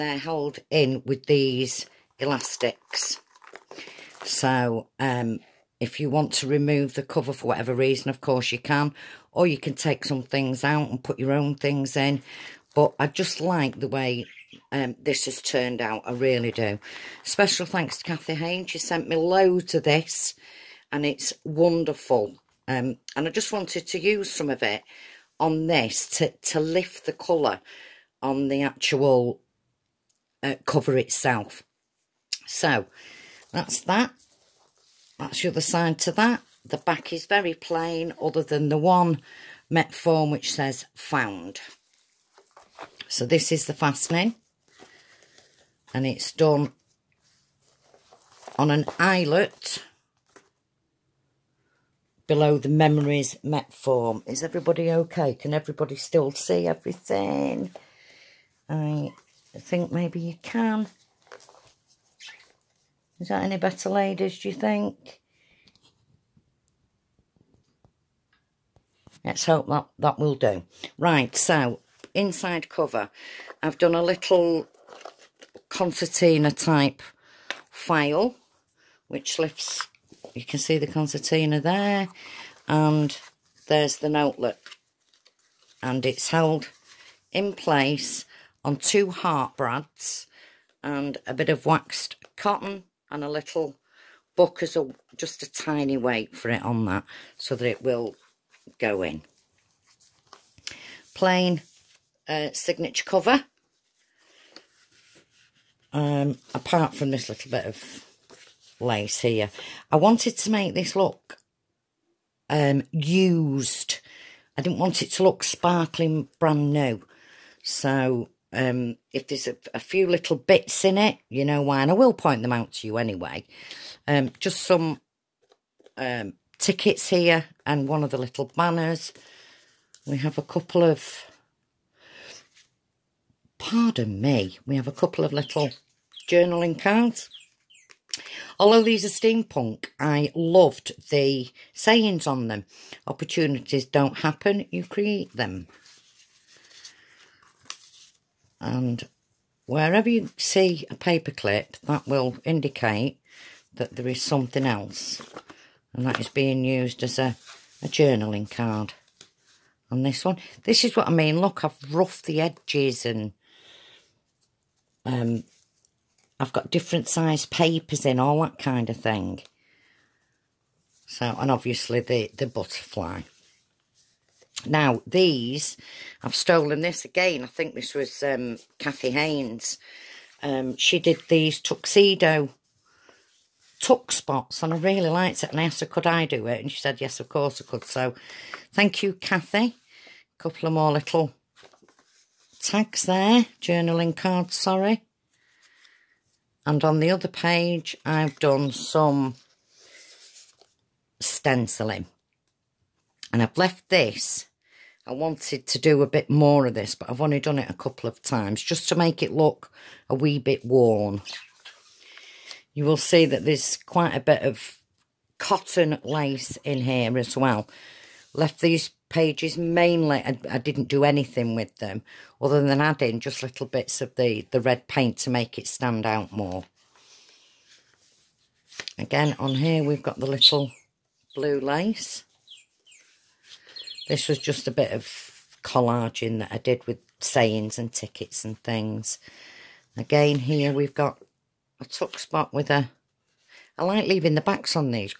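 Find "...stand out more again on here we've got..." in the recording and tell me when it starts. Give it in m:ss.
3:45.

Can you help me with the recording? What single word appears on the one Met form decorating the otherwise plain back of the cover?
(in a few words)
found.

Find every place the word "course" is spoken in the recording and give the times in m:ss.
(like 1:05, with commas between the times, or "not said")
0:08, 3:07.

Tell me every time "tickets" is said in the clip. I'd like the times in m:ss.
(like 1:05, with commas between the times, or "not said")
2:06, 3:57.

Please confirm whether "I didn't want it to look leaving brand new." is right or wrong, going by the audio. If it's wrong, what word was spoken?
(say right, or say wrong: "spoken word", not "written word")
wrong: "sparkling", not "leaving".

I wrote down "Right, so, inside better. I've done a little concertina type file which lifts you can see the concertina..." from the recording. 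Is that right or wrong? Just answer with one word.
wrong.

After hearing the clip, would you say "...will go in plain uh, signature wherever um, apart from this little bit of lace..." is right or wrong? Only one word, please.
wrong.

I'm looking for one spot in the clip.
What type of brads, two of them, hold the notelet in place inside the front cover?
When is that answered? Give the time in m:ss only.
1:29.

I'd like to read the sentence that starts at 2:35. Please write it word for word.
And that is being used as a, a journaling card on this one.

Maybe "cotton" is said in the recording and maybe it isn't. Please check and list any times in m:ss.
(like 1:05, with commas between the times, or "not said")
1:32, 3:35.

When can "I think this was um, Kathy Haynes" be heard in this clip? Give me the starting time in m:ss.
2:57.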